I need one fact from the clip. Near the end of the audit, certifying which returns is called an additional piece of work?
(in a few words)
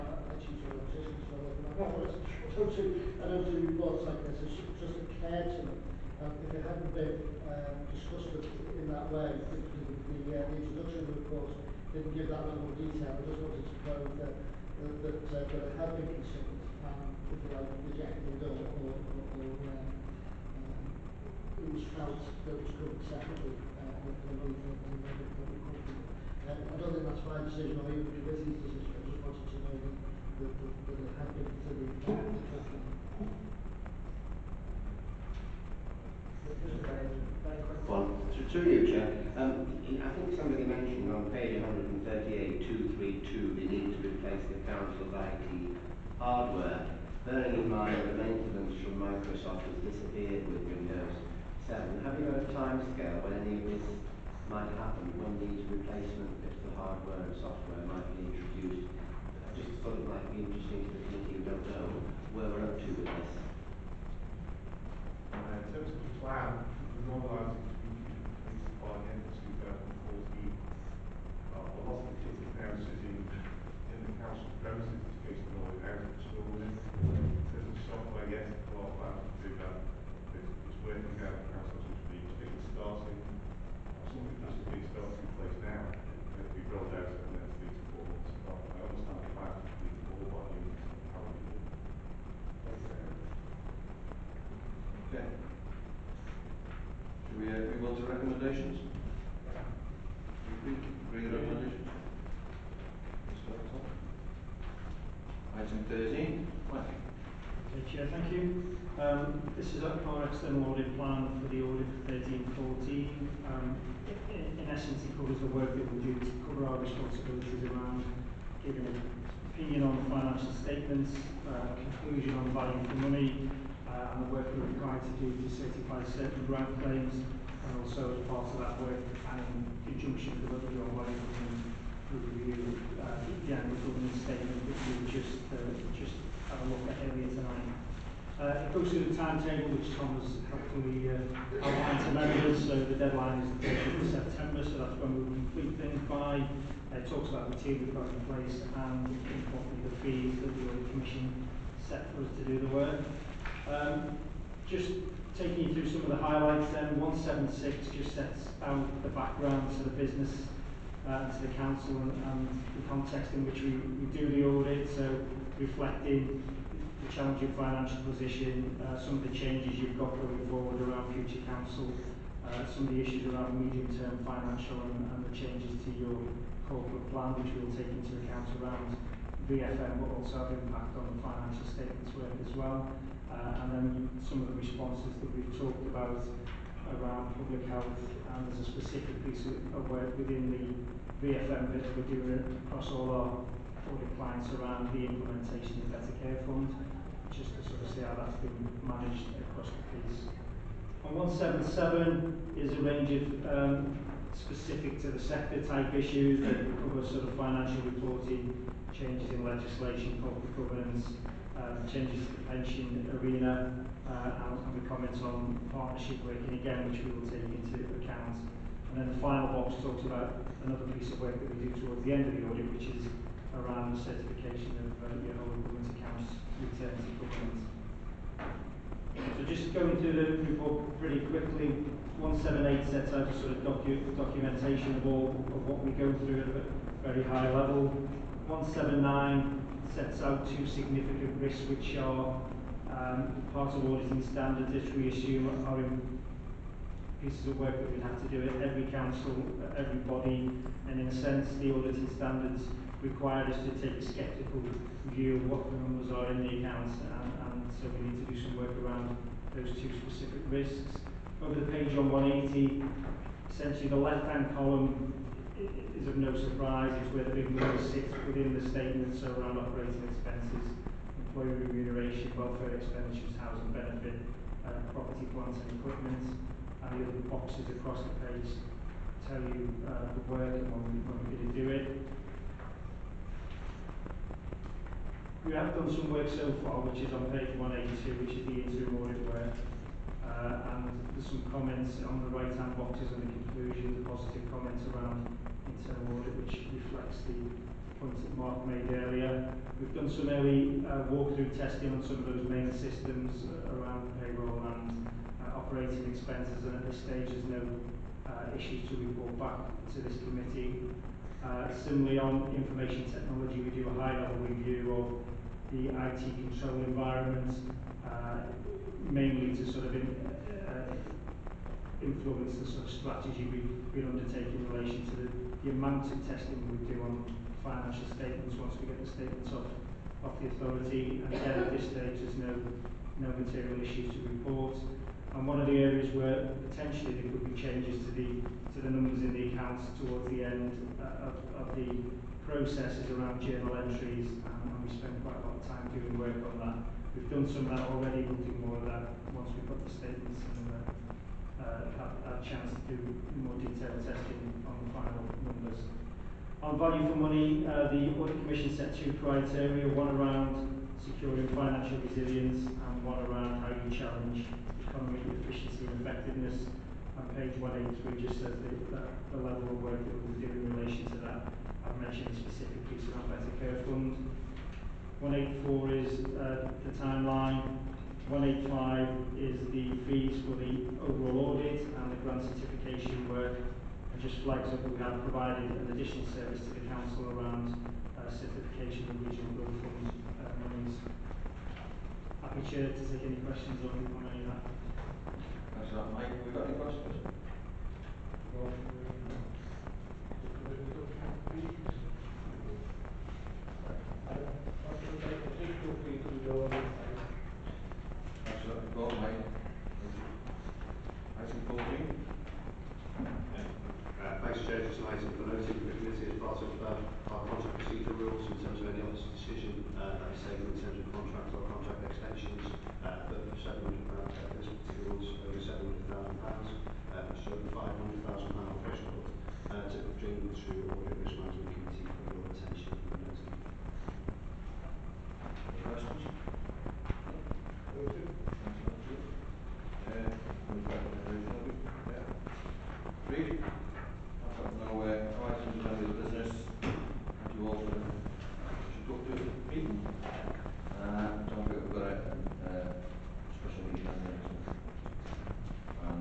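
Whole government accounts.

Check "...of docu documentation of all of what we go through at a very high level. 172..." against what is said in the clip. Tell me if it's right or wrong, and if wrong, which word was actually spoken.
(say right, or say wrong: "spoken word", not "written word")
wrong: "179", not "172".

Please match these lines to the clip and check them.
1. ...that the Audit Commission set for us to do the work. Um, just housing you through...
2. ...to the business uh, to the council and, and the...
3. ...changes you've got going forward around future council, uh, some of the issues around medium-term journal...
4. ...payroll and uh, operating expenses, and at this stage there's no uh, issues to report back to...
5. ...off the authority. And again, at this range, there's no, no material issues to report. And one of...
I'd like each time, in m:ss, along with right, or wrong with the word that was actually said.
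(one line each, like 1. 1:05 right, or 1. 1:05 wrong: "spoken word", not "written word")
1. 2:30 wrong: "taking", not "housing"
2. 2:39 right
3. 2:49 wrong: "financial", not "journal"
4. 5:04 right
5. 5:30 wrong: "stage", not "range".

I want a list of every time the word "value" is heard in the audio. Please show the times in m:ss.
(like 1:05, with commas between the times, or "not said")
2:02, 5:56.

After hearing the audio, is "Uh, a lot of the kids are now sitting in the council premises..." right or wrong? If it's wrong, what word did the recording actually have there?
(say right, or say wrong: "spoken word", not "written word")
right.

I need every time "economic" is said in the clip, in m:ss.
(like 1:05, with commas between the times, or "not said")
6:04.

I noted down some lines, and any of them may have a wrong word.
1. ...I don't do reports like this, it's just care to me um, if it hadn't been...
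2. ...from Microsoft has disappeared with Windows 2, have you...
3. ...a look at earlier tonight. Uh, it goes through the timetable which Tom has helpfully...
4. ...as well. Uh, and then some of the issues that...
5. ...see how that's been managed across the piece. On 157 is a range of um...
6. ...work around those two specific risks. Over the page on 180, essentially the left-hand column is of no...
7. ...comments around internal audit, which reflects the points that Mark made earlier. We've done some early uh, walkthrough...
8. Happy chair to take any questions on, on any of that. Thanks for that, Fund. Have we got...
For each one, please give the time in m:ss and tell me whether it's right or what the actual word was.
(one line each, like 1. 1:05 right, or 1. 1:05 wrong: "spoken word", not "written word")
1. 0:02 right
2. 0:48 wrong: "7", not "2"
3. 2:16 right
4. 3:02 wrong: "responses", not "issues"
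5. 3:17 wrong: "177", not "157"
6. 4:18 right
7. 4:54 right
8. 6:32 wrong: "Mike", not "Fund".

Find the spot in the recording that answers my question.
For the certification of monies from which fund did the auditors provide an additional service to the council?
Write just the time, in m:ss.
6:29.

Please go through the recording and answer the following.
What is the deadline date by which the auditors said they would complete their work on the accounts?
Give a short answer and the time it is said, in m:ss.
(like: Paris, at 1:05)
30th of September, at 2:23.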